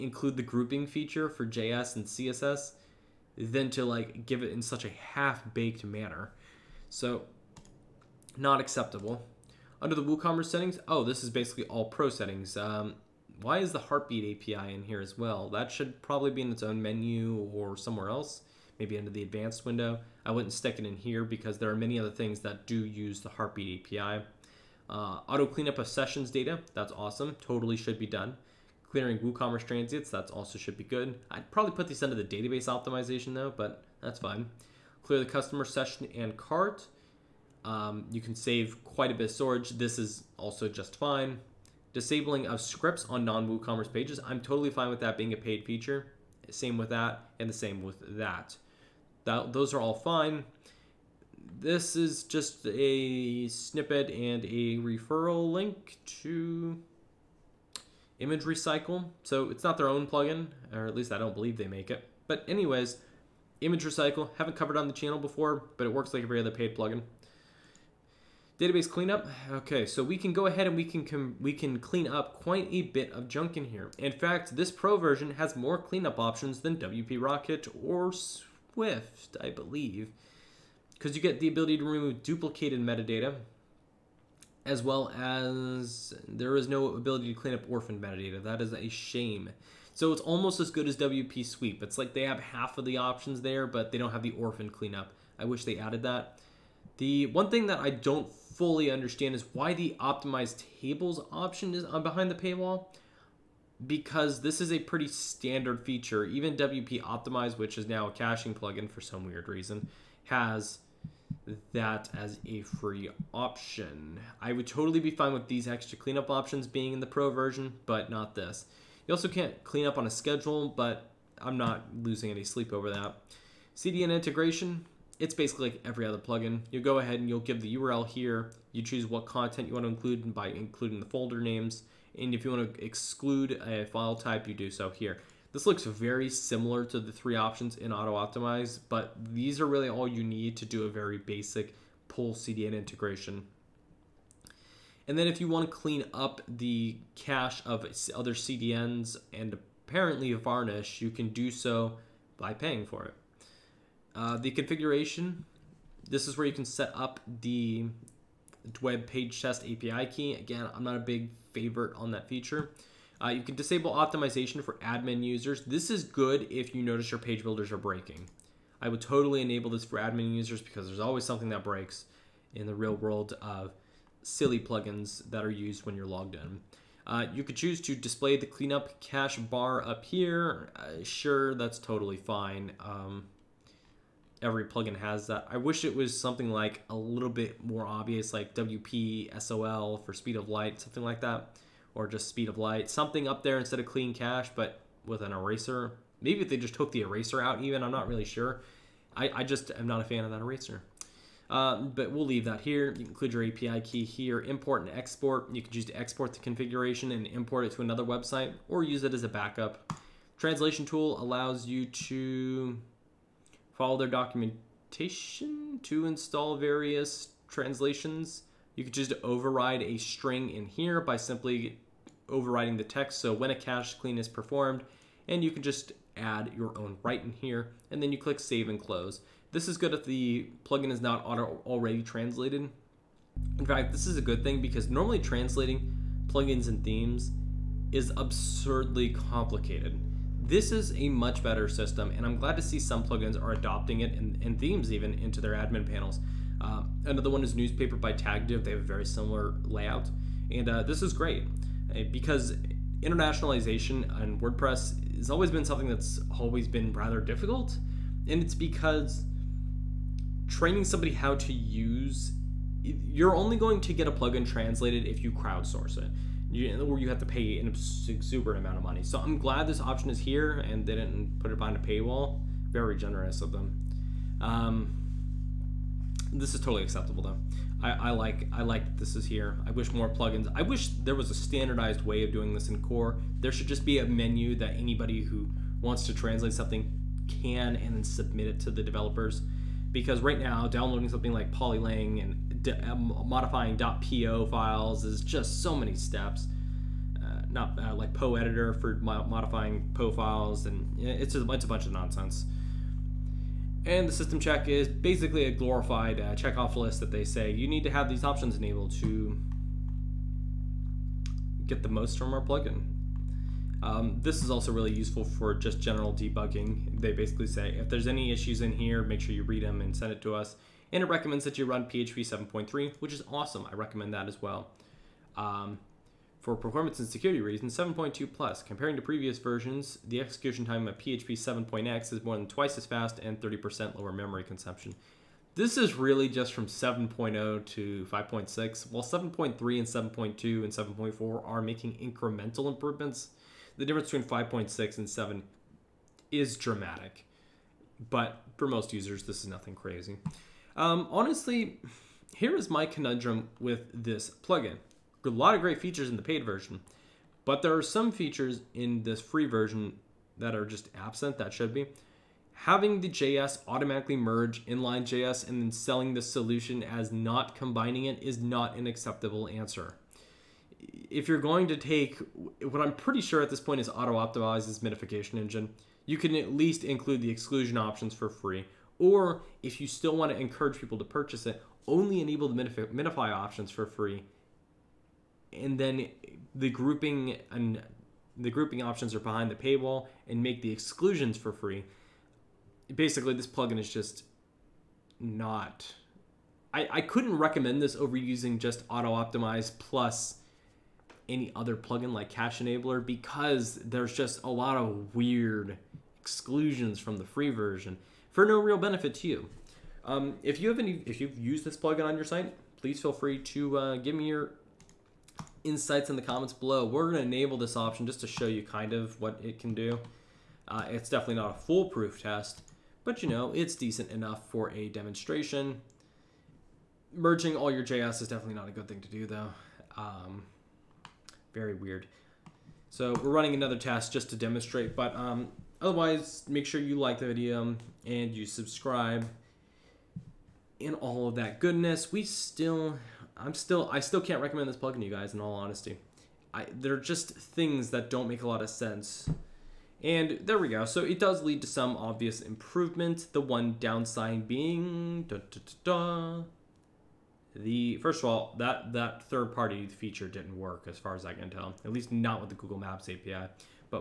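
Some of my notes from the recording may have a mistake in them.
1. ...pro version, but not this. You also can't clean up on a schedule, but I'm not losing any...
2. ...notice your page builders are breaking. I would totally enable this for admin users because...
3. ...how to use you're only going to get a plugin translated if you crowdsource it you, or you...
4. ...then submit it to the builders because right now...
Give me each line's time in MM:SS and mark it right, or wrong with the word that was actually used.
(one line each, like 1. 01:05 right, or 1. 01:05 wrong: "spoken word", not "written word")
1. 01:57 right
2. 02:46 right
3. 04:21 right
4. 04:47 wrong: "developers", not "builders".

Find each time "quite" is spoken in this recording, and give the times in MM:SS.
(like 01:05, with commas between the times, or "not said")
00:38, 01:12.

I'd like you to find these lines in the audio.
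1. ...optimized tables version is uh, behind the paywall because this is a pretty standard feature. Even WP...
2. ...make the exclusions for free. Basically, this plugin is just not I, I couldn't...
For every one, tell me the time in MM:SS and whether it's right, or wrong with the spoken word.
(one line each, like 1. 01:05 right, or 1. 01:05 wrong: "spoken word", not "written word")
1. 01:40 wrong: "option", not "version"
2. 06:30 right.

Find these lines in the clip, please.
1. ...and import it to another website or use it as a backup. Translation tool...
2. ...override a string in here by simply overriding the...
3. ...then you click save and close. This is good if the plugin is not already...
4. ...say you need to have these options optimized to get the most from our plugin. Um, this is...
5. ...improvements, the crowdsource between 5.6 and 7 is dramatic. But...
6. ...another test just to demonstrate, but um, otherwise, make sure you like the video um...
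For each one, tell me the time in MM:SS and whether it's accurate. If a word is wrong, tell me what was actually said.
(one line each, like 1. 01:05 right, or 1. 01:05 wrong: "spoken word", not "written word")
1. 03:27 right
2. 03:39 right
3. 03:48 right
4. 05:07 wrong: "enabled", not "optimized"
5. 05:42 wrong: "difference", not "crowdsource"
6. 07:13 right.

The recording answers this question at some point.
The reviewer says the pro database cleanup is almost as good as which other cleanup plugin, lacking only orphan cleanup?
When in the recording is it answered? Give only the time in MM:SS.
01:30.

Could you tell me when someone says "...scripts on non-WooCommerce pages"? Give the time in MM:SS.
00:42.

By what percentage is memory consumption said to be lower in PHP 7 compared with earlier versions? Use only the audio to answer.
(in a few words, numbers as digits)
30%.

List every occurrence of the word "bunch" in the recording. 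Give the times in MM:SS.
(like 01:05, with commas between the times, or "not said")
05:01.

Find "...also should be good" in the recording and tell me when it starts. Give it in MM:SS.
00:30.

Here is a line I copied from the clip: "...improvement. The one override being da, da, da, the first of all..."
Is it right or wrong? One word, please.
wrong.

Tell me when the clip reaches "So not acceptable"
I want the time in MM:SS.
00:06.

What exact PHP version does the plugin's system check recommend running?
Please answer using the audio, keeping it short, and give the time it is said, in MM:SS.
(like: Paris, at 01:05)
7.3, at 05:21.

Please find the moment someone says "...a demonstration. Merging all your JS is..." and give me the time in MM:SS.
07:04.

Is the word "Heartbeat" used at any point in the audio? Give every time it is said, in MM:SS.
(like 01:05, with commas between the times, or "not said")
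00:13, 00:23.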